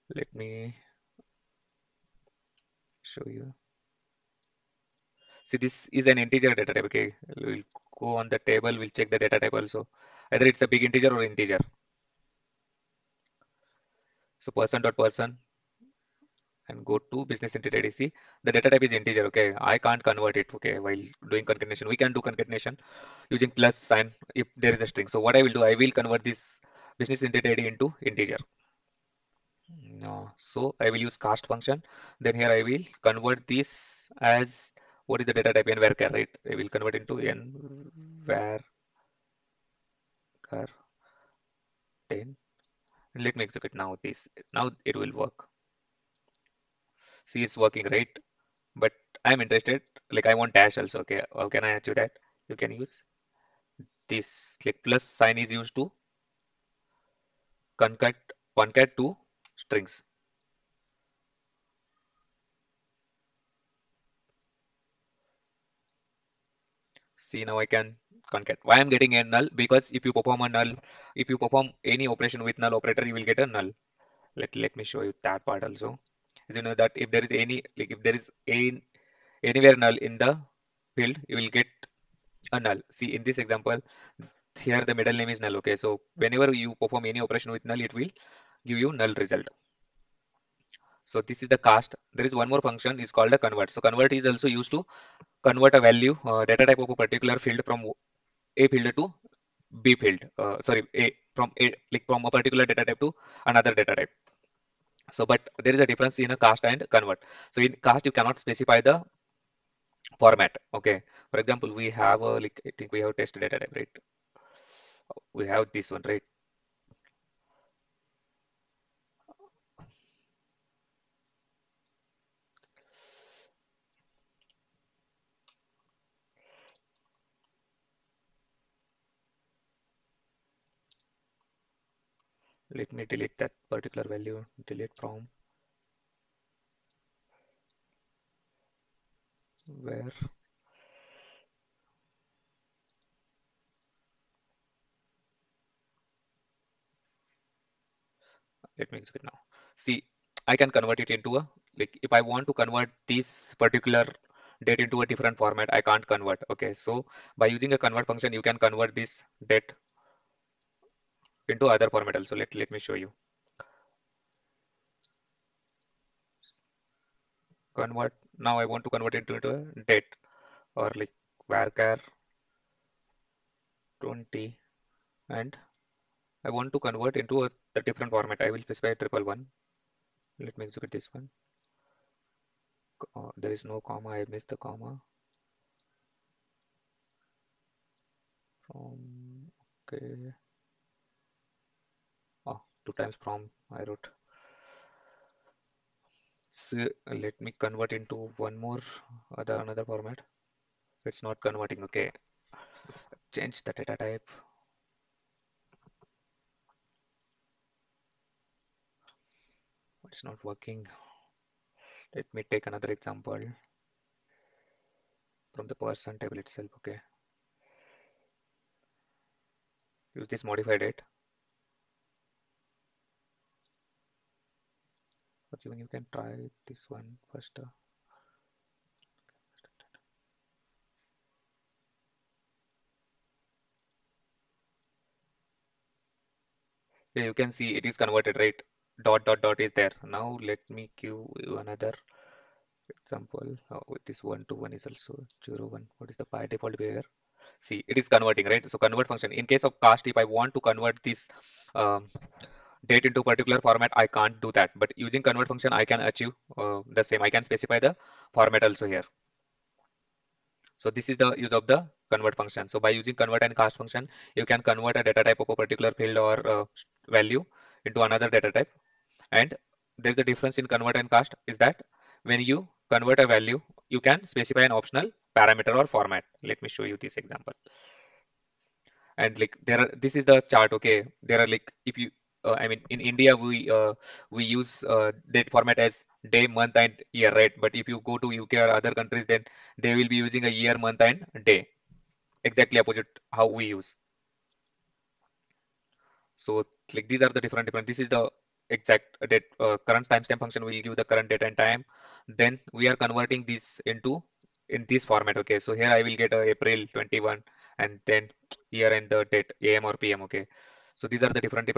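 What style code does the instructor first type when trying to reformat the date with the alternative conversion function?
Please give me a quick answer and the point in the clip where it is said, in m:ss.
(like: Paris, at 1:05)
111, at 2:58.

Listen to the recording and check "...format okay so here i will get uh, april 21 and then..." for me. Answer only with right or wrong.
right.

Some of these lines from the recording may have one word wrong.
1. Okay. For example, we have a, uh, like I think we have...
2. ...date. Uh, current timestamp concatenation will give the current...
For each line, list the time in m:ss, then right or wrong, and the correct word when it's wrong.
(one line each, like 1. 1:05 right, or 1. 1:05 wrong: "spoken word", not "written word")
1. 1:50 right
2. 4:59 wrong: "function", not "concatenation".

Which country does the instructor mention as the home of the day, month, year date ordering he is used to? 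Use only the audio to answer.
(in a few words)
India.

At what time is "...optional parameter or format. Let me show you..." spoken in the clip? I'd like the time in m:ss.
4:34.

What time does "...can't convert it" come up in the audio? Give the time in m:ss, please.
0:19.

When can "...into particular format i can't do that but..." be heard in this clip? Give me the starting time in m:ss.
4:13.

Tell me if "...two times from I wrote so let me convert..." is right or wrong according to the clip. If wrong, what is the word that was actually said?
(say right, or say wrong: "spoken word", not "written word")
right.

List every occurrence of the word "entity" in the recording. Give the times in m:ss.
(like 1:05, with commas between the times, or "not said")
0:17, 0:27.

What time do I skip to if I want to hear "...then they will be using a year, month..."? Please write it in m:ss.
4:49.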